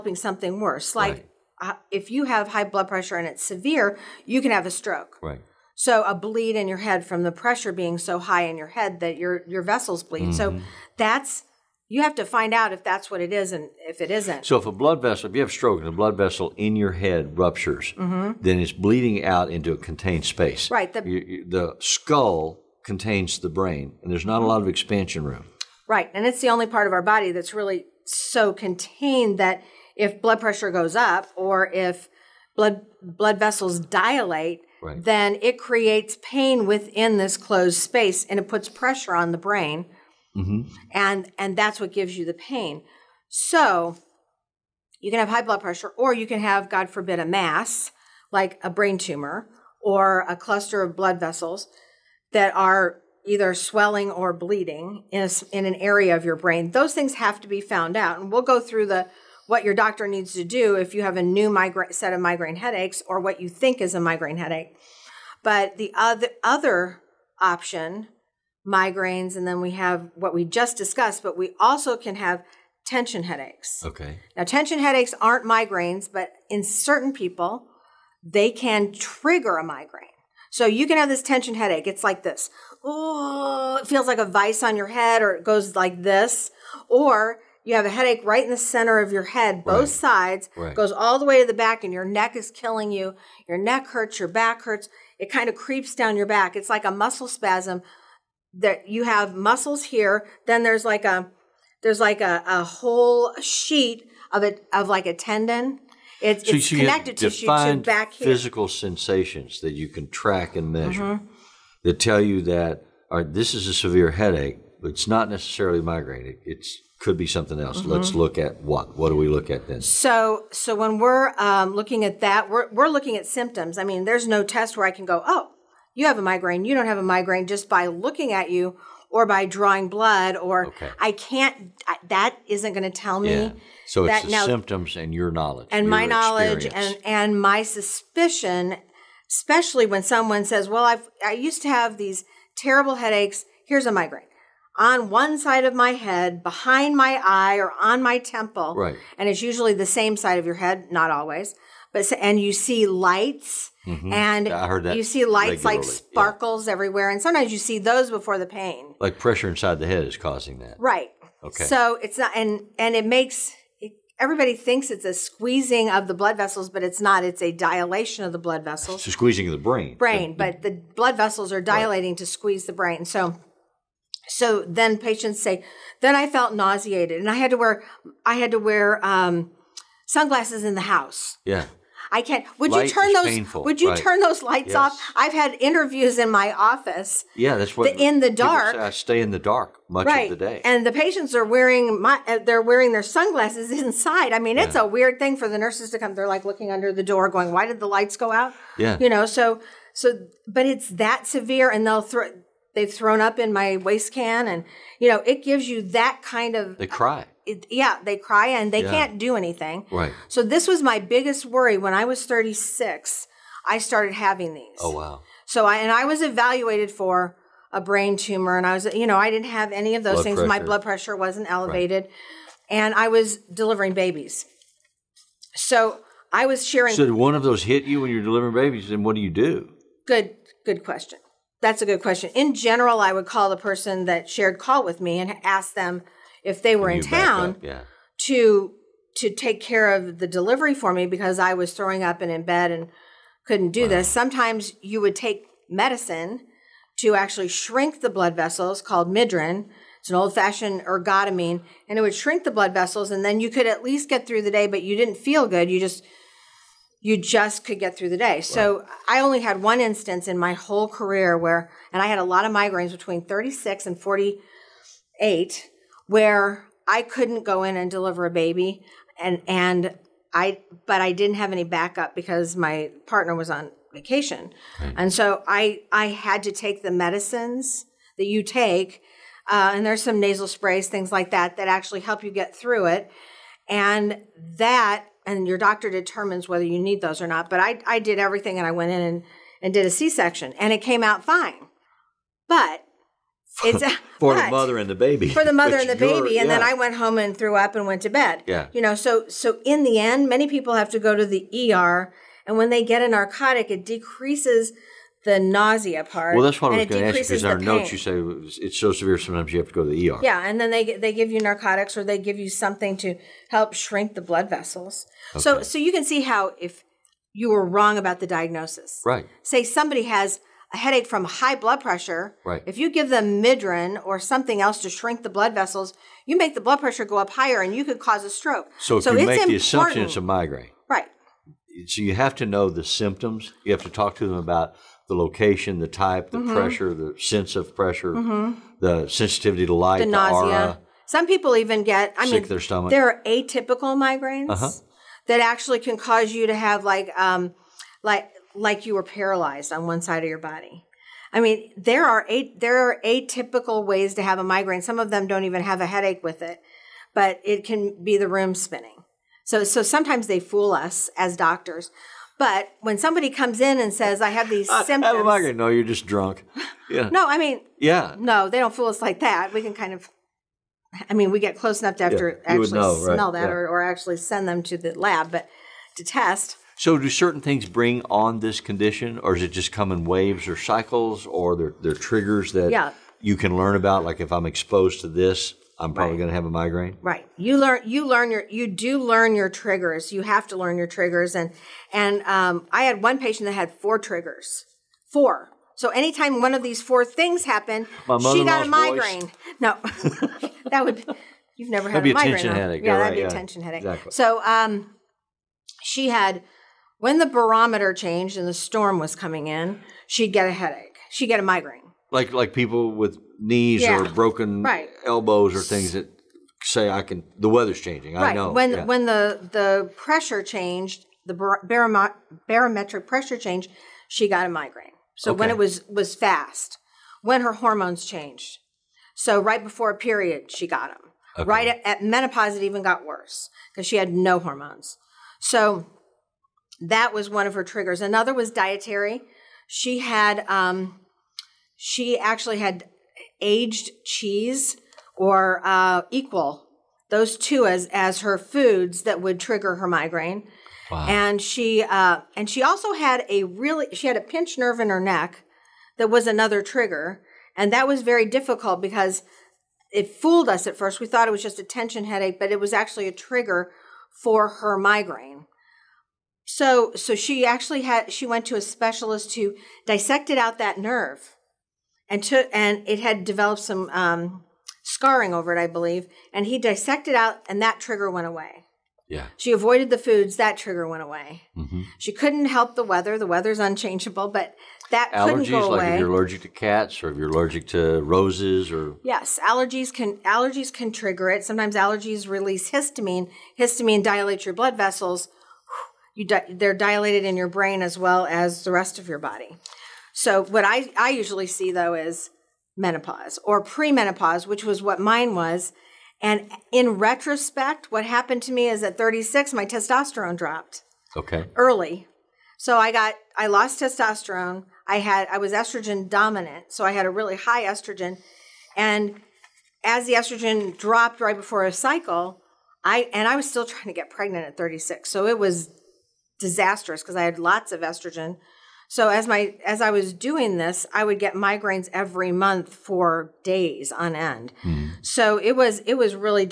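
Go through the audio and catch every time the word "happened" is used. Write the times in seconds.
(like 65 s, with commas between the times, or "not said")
397 s, 508 s.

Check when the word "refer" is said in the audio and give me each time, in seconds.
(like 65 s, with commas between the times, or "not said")
not said.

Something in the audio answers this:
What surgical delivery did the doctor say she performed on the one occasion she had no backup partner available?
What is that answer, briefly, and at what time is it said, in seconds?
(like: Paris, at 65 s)
C-section, at 289 s.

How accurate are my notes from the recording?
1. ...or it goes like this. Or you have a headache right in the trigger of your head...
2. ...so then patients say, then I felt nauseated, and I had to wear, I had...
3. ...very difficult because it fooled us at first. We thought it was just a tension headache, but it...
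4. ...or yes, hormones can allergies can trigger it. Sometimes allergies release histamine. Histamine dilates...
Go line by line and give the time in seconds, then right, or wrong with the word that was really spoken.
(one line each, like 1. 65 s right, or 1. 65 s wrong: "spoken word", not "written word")
1. 85 s wrong: "center", not "trigger"
2. 174 s right
3. 458 s right
4. 488 s wrong: "allergies", not "hormones".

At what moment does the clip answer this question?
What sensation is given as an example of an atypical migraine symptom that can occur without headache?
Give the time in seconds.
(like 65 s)
358 s.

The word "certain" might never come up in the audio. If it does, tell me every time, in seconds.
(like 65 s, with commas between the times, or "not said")
76 s, 377 s.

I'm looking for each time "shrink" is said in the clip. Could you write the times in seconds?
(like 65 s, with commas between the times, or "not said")
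247 s, 252 s, 313 s, 324 s.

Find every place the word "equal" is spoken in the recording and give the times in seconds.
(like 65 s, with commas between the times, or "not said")
446 s.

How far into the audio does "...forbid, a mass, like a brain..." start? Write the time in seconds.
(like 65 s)
46 s.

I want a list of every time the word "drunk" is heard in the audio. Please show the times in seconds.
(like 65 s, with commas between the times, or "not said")
366 s.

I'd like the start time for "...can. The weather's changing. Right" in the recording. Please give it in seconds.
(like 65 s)
417 s.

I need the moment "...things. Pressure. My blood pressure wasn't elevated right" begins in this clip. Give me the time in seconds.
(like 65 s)
220 s.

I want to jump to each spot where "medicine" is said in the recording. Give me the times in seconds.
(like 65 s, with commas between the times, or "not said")
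245 s, 276 s.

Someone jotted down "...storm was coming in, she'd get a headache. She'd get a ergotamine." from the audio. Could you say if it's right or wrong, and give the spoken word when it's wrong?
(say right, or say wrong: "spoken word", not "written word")
wrong: "migraine", not "ergotamine".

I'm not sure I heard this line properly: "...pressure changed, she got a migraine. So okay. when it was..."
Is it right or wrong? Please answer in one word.
right.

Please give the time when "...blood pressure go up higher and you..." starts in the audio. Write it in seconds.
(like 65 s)
326 s.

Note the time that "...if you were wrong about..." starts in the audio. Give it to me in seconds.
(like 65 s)
316 s.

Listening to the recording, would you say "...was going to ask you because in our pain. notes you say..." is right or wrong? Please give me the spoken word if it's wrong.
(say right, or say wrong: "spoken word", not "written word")
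right.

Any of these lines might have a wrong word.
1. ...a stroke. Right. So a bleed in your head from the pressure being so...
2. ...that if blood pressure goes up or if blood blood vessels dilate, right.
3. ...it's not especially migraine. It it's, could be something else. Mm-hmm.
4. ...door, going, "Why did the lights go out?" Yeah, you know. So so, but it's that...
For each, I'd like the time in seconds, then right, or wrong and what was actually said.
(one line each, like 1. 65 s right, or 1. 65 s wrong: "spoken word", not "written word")
1. 4 s right
2. 29 s right
3. 114 s wrong: "necessarily", not "especially"
4. 197 s right.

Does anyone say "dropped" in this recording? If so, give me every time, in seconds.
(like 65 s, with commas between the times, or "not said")
510 s, 520 s.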